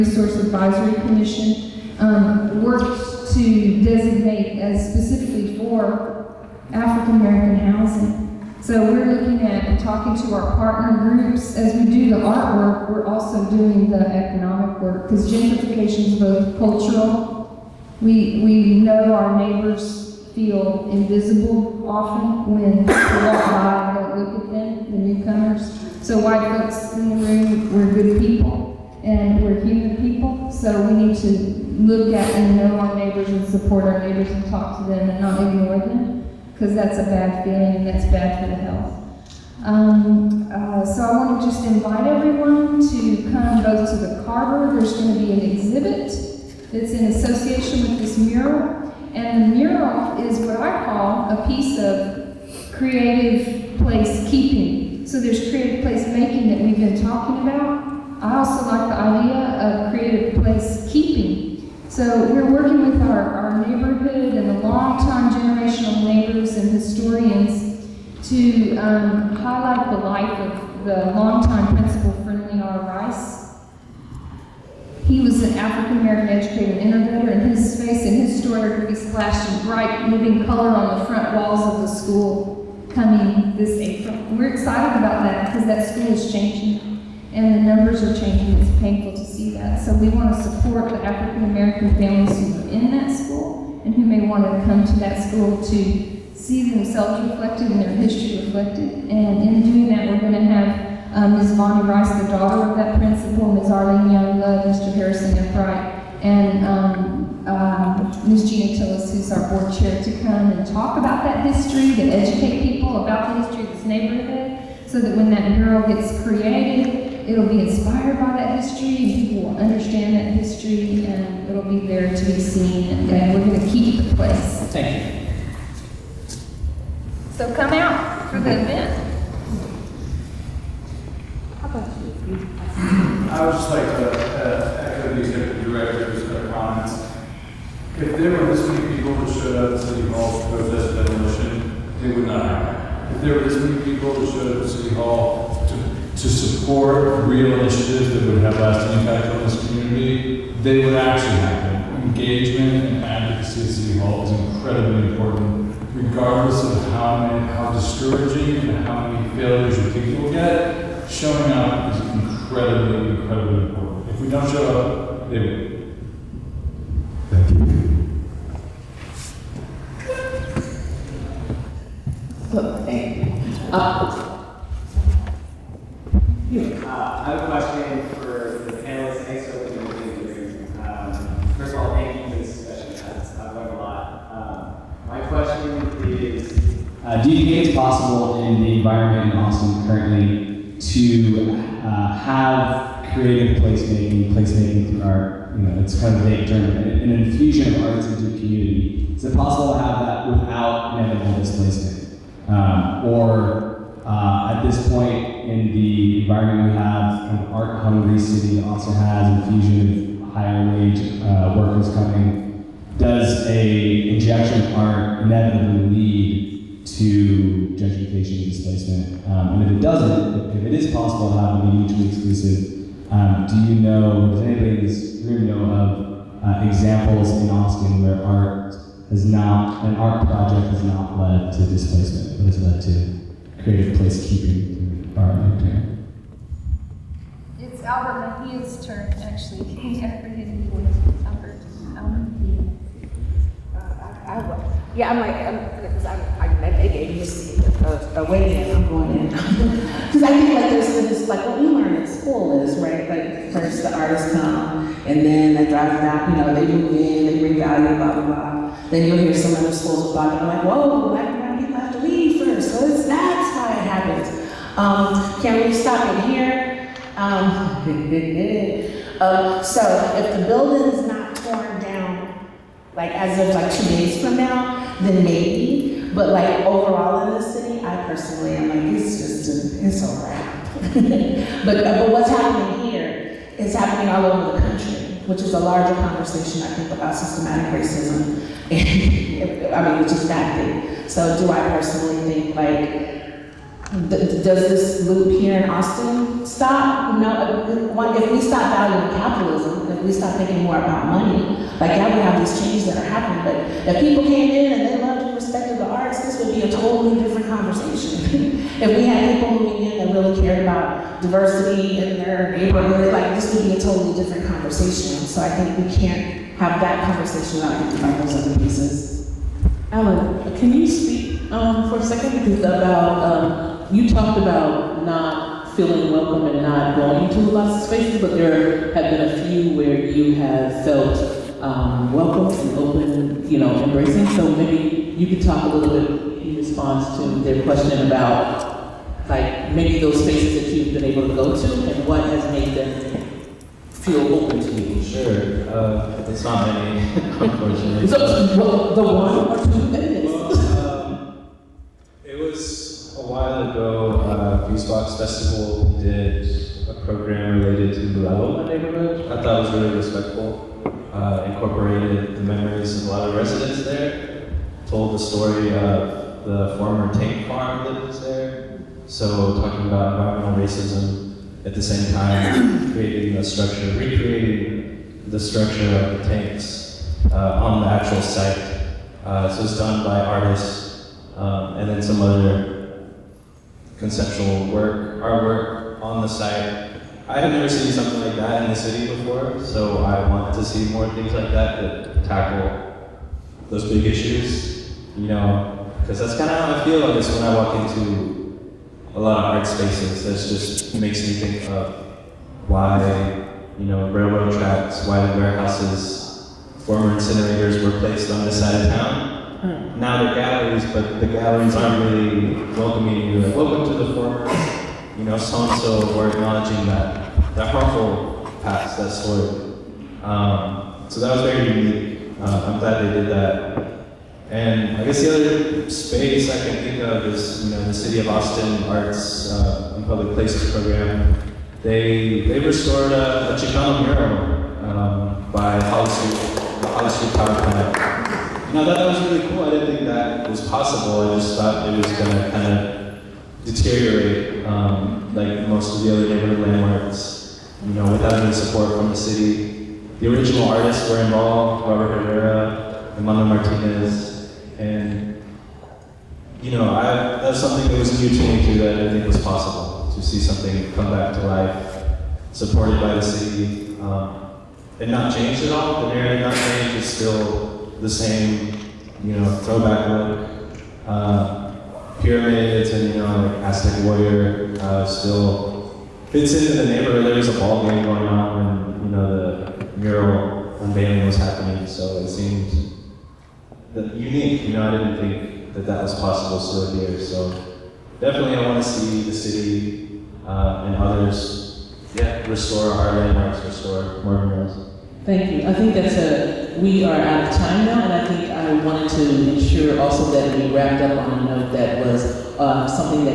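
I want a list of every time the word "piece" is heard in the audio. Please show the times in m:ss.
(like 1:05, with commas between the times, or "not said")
0:51, 5:18.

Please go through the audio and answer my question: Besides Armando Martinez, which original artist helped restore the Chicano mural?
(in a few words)
Robert Herrera.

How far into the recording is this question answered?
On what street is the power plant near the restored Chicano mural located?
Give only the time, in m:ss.
7:15.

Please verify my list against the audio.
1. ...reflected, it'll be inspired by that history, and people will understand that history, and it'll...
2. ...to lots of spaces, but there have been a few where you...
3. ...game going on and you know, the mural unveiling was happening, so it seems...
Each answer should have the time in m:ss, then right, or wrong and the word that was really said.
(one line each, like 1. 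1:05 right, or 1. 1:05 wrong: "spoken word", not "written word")
1. 1:56 wrong: "created", not "reflected"
2. 5:27 right
3. 7:57 right.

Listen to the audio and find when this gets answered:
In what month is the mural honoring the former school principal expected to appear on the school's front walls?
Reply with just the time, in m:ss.
1:23.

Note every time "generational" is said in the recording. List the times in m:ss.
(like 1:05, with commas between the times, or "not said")
1:05.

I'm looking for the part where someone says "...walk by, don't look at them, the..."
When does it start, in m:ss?
0:22.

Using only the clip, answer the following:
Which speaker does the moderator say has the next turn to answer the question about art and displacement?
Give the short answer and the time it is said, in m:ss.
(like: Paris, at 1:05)
Albert Mejia, at 3:57.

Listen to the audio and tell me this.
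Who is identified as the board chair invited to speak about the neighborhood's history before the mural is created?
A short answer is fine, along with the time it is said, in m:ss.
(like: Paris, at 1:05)
Gina Tillis, at 1:48.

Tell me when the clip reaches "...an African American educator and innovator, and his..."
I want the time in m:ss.
1:15.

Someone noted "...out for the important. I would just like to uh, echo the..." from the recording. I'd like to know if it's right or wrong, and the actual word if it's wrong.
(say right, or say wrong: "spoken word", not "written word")
wrong: "event", not "important".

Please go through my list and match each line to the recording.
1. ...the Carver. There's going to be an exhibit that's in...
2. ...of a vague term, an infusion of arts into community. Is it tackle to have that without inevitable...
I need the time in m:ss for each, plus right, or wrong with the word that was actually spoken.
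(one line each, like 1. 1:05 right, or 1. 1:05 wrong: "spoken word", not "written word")
1. 0:43 right
2. 3:16 wrong: "possible", not "tackle".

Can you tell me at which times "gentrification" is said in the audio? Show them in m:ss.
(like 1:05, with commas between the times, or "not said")
0:15, 3:37.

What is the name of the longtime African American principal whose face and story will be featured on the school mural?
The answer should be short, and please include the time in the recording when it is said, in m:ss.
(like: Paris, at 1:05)
Friendly R. Rice, at 1:12.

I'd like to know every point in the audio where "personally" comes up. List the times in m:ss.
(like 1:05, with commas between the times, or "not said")
4:38, 4:51.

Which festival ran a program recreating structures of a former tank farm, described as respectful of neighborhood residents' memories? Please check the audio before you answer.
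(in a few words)
Fusebox Festival.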